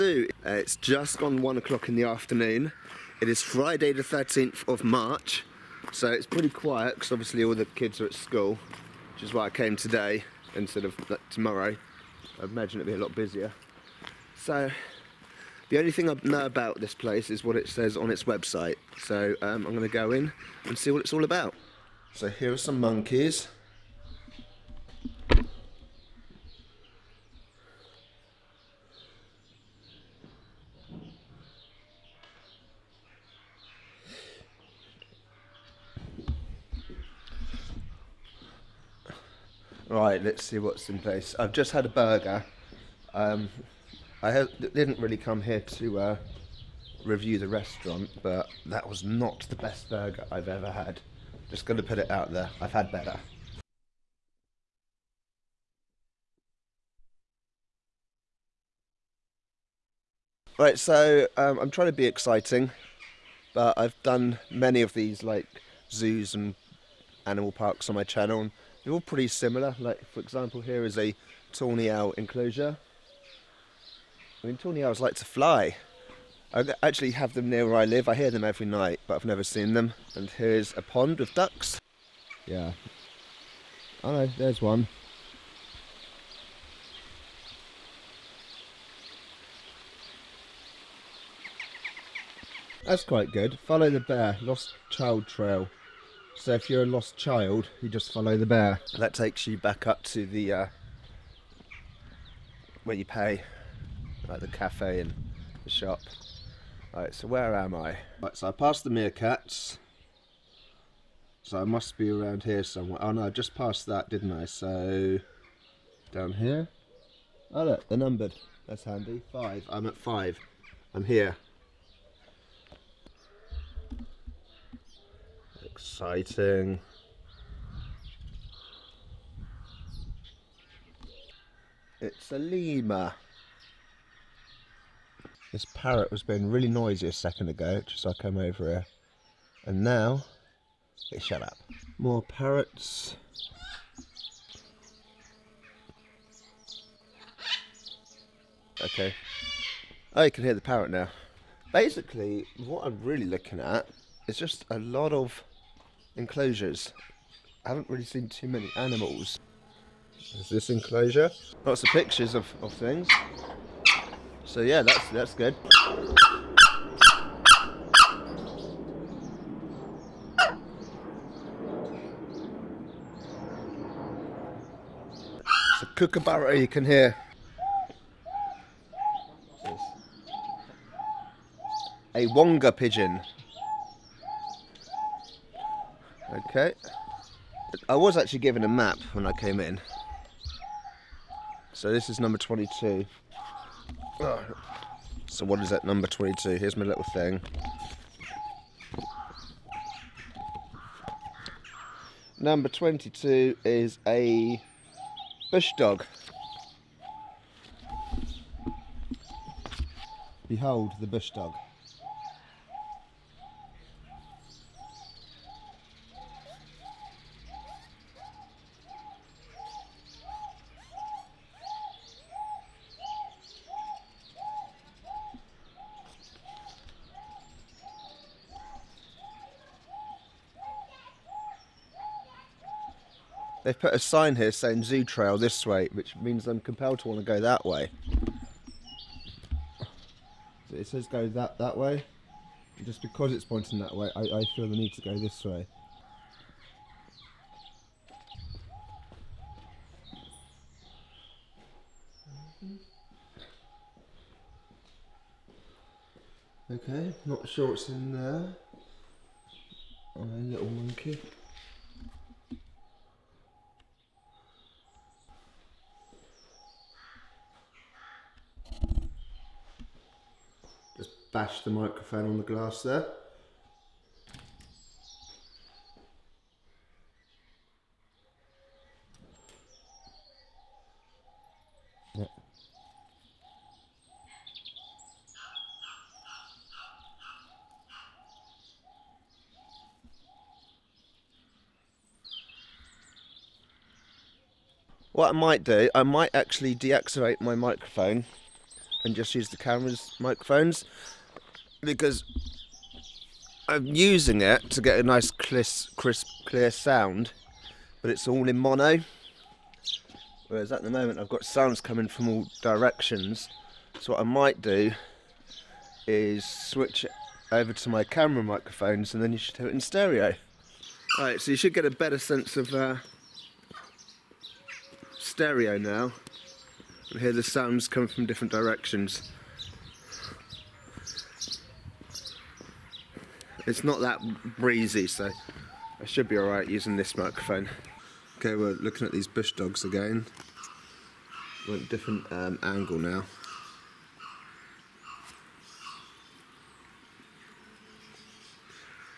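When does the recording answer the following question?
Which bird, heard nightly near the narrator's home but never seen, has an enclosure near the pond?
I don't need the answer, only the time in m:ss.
1:11.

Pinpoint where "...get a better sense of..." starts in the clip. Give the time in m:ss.
5:21.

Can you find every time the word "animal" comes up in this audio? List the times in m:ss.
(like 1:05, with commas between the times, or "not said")
1:07, 2:38.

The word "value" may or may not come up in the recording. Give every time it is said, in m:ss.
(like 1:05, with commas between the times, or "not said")
not said.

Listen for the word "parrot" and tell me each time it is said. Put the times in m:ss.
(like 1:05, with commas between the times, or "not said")
2:15, 2:22, 2:30.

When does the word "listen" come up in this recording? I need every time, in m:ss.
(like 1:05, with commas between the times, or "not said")
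not said.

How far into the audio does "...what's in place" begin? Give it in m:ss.
0:40.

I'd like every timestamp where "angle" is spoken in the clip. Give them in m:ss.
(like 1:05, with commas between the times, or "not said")
5:42.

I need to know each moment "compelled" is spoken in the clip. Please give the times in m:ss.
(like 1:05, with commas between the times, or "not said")
3:56.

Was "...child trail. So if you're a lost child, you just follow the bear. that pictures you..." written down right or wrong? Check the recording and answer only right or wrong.
wrong.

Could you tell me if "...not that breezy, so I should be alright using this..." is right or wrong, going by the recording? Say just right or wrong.
right.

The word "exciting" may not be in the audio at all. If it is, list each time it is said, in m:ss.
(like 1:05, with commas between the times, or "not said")
1:02, 2:05.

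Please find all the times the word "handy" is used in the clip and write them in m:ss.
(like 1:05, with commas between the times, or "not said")
1:58.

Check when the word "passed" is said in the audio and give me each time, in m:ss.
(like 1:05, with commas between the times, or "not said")
1:48, 1:53.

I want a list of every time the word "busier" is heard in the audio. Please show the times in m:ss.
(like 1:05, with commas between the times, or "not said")
0:13.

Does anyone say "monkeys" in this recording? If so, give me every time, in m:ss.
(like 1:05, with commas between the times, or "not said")
0:22, 4:20.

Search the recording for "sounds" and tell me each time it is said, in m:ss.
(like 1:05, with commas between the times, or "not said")
5:06, 5:11, 5:27.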